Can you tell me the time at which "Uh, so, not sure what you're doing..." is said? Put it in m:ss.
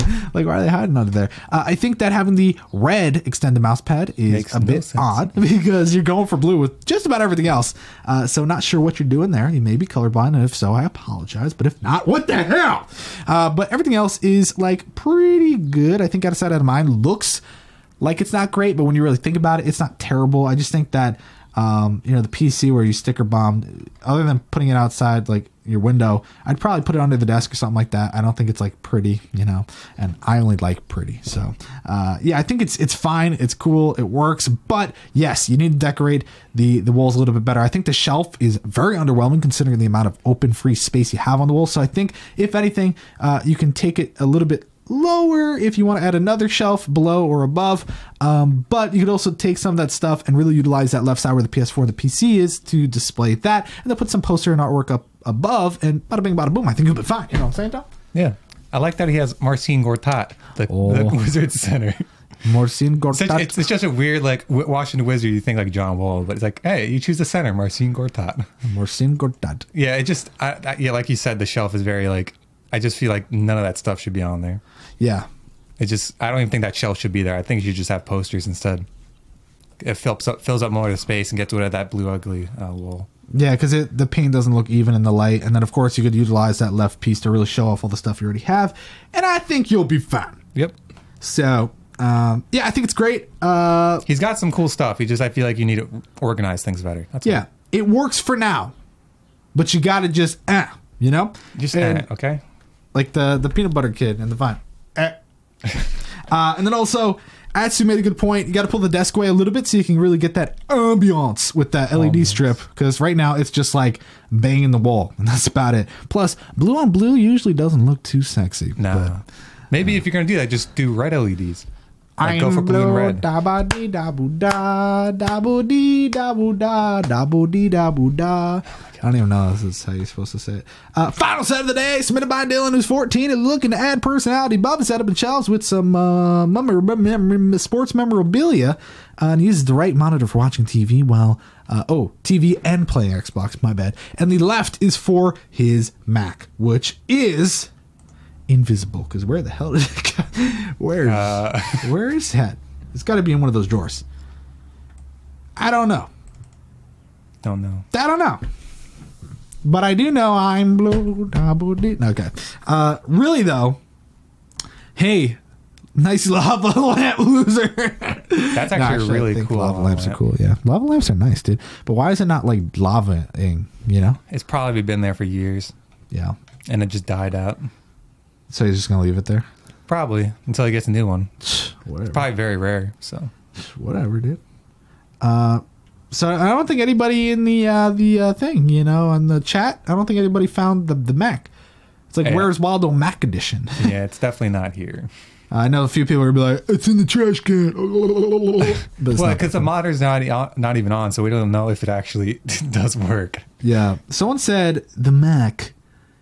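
0:08.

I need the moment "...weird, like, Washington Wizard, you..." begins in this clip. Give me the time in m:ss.
1:03.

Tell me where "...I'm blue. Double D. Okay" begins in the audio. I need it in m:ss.
2:40.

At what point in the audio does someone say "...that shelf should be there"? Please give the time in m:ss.
1:16.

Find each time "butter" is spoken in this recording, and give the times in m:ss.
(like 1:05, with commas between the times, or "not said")
1:43.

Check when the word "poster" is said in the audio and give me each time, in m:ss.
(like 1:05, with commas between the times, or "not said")
0:54, 1:18.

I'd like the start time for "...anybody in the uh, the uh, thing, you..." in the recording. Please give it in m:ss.
3:06.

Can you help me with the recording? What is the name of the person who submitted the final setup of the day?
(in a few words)
Dylan.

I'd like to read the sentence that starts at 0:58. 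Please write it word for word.
I like that he has Marcin Gortat, the, oh.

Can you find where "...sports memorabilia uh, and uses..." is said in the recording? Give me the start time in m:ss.
2:17.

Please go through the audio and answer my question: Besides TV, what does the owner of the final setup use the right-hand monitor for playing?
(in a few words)
Xbox.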